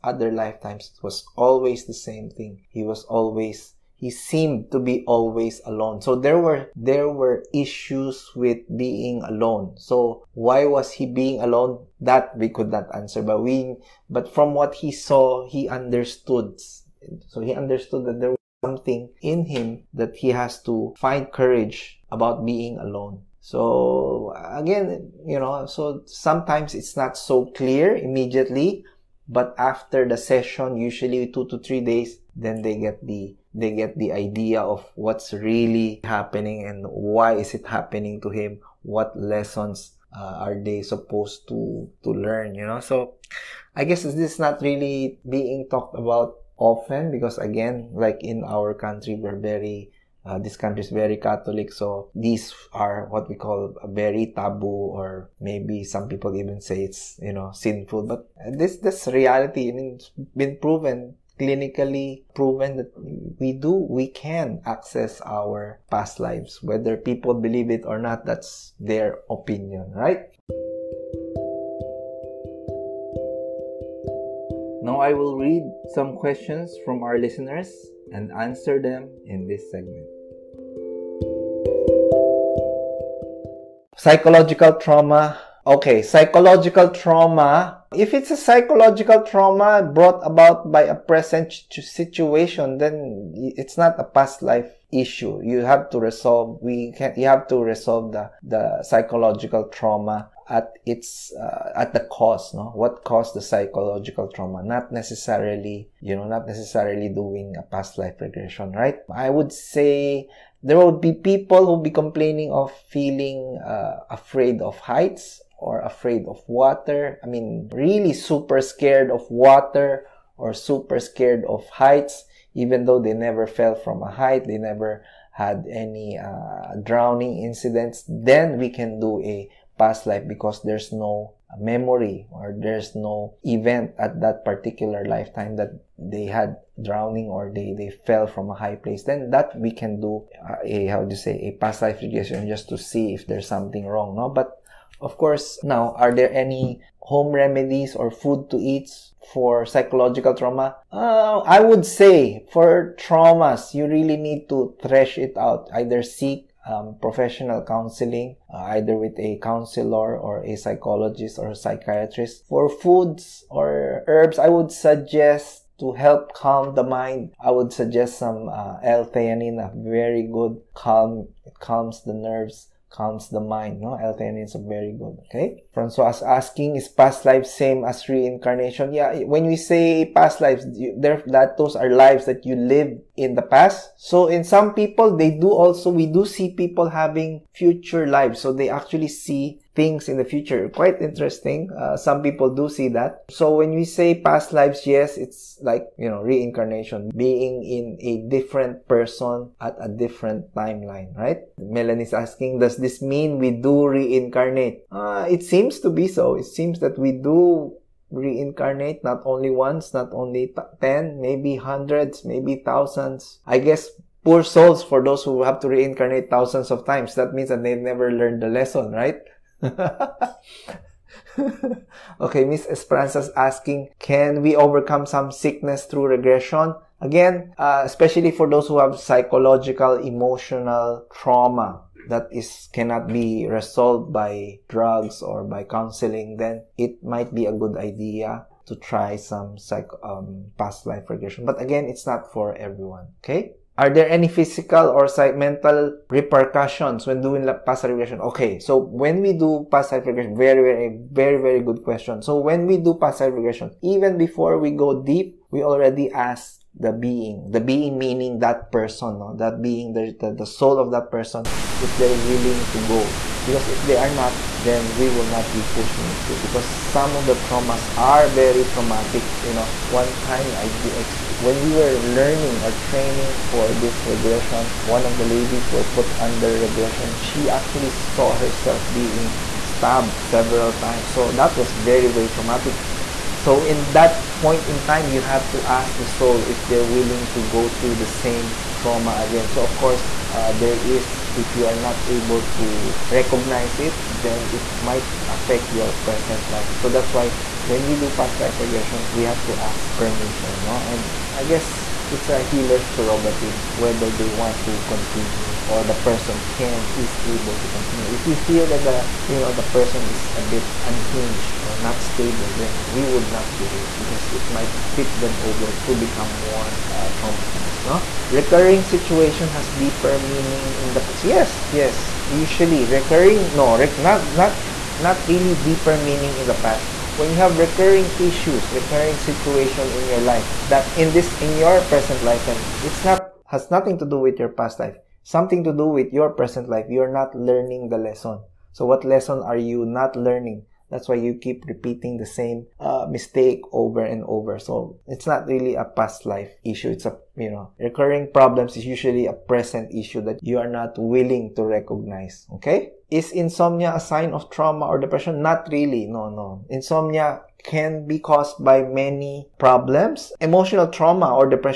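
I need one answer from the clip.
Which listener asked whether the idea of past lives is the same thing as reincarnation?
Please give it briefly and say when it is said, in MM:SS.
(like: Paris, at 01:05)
Francois, at 02:55.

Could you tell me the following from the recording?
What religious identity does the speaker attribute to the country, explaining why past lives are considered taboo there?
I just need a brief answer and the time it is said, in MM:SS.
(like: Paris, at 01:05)
Catholic, at 00:51.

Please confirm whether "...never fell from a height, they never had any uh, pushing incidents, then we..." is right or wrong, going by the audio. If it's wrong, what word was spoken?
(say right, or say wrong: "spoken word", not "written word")
wrong: "drowning", not "pushing".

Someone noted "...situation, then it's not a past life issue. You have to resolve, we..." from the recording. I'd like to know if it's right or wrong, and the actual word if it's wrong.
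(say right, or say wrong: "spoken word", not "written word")
right.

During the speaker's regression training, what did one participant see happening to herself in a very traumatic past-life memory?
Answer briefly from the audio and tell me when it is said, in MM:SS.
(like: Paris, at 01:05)
being stabbed several times, at 04:39.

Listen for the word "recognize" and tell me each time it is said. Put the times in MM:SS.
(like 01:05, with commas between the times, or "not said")
04:53, 05:51.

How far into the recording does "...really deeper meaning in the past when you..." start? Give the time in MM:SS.
05:25.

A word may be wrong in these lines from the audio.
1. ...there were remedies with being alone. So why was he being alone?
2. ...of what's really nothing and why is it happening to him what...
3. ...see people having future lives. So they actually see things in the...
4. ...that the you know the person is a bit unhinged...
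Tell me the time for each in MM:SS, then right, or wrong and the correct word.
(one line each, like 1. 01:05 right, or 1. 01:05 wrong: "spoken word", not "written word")
1. 00:06 wrong: "issues", not "remedies"
2. 00:34 wrong: "happening", not "nothing"
3. 03:06 right
4. 05:08 right.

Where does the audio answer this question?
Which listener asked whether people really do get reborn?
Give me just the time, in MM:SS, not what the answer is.
03:21.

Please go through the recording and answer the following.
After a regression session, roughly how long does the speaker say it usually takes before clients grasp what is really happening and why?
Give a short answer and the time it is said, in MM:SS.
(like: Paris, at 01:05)
2 to 3 days, at 00:31.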